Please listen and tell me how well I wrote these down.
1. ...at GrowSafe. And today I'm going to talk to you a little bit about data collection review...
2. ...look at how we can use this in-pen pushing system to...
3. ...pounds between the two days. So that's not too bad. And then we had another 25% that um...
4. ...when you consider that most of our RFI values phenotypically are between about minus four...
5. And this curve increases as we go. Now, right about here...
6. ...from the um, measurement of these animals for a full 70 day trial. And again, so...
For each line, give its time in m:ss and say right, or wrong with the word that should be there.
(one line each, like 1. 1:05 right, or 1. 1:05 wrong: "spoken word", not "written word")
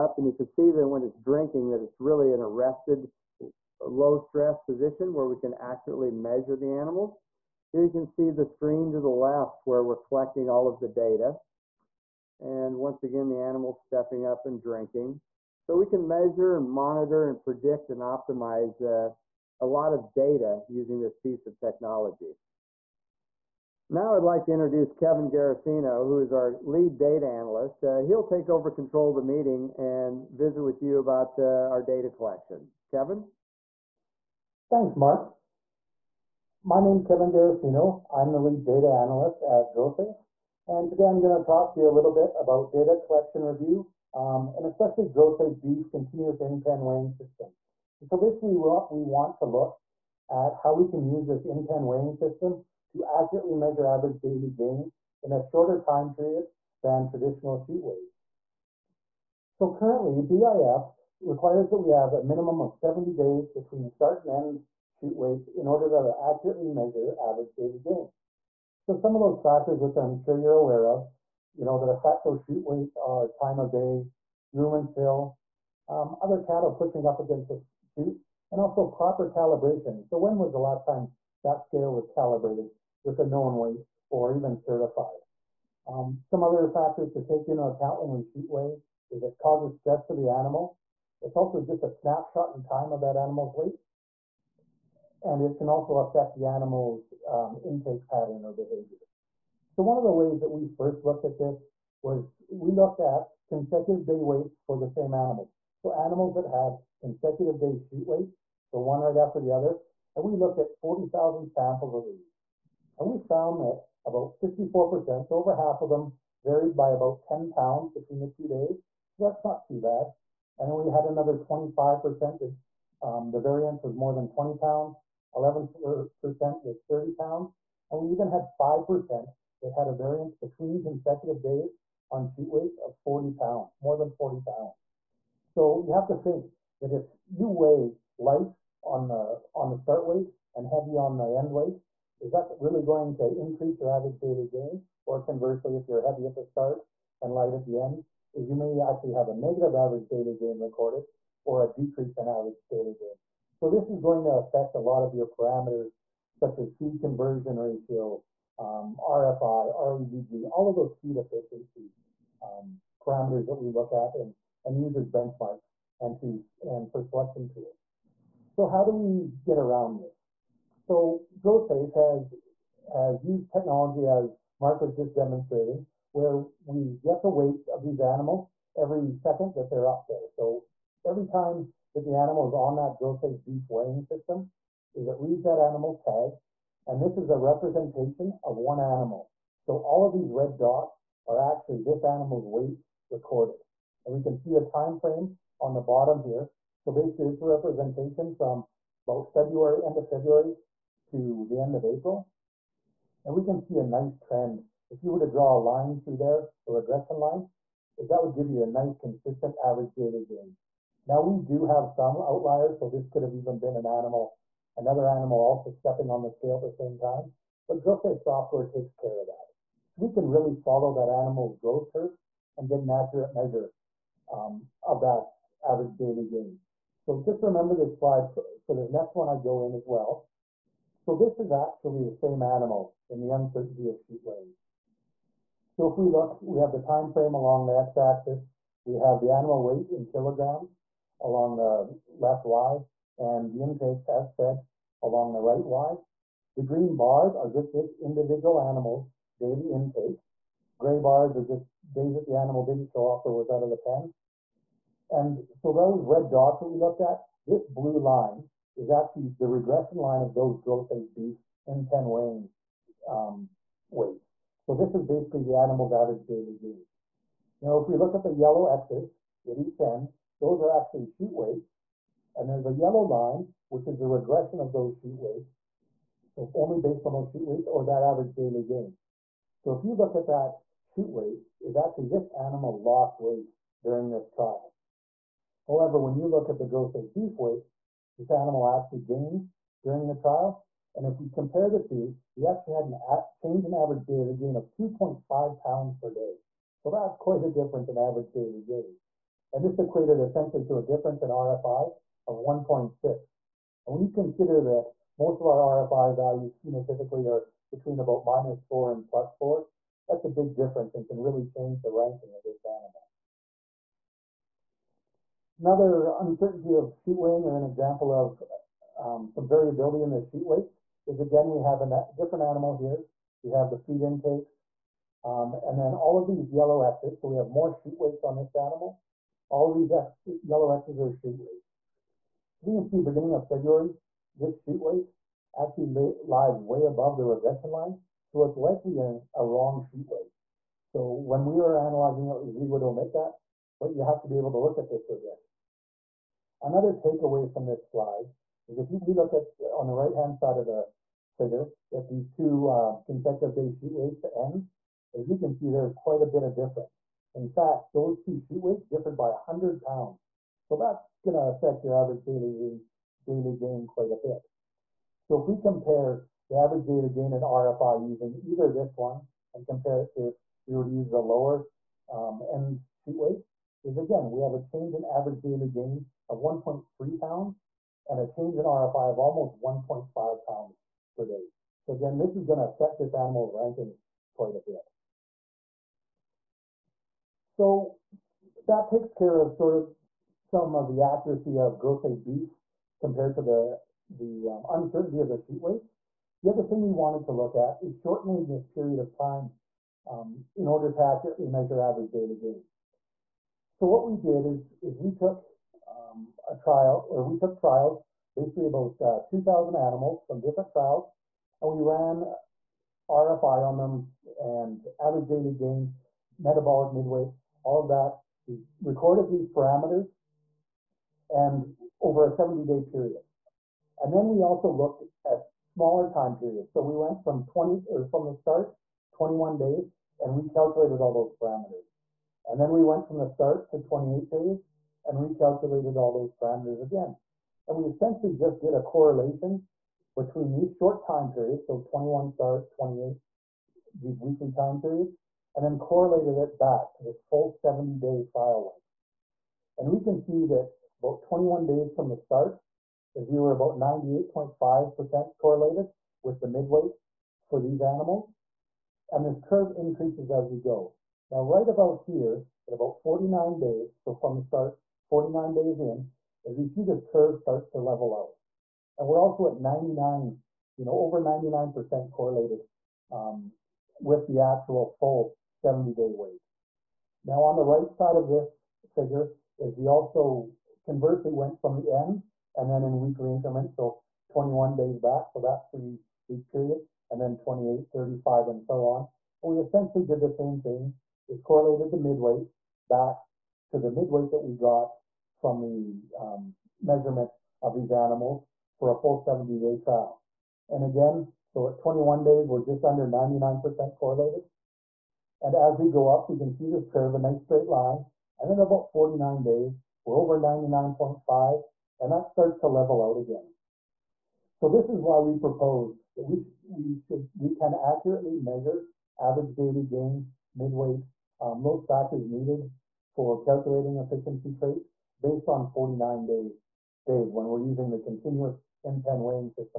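1. 0:39 right
2. 0:49 wrong: "weighing", not "pushing"
3. 1:57 right
4. 5:03 right
5. 7:39 right
6. 8:15 right.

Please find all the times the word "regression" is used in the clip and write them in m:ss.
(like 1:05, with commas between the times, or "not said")
3:26, 4:19, 4:34, 5:37, 5:45.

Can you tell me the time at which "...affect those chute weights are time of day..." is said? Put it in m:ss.
1:11.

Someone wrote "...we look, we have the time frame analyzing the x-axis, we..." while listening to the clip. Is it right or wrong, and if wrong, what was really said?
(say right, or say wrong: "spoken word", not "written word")
wrong: "along", not "analyzing".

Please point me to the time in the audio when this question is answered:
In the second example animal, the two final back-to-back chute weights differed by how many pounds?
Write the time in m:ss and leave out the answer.
5:59.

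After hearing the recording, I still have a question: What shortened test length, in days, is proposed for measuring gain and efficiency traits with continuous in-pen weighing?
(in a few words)
49.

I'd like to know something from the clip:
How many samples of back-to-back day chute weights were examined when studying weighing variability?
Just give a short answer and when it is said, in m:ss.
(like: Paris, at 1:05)
40,000, at 1:50.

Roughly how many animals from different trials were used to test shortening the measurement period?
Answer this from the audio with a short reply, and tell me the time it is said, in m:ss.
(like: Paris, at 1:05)
2000, at 6:49.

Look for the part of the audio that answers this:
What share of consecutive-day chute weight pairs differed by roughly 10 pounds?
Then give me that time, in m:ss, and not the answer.
1:54.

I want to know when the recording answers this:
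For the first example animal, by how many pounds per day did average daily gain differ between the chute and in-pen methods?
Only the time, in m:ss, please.
4:54.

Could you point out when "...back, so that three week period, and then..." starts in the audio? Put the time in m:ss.
8:04.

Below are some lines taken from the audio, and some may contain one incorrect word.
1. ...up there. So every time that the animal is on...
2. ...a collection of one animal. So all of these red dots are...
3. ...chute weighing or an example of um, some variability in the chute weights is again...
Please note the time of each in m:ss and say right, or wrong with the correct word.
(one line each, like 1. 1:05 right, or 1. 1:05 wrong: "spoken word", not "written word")
1. 2:59 right
2. 3:07 wrong: "representation", not "collection"
3. 5:16 right.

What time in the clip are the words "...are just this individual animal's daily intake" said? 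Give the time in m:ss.
4:07.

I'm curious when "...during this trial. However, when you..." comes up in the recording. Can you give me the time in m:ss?
4:43.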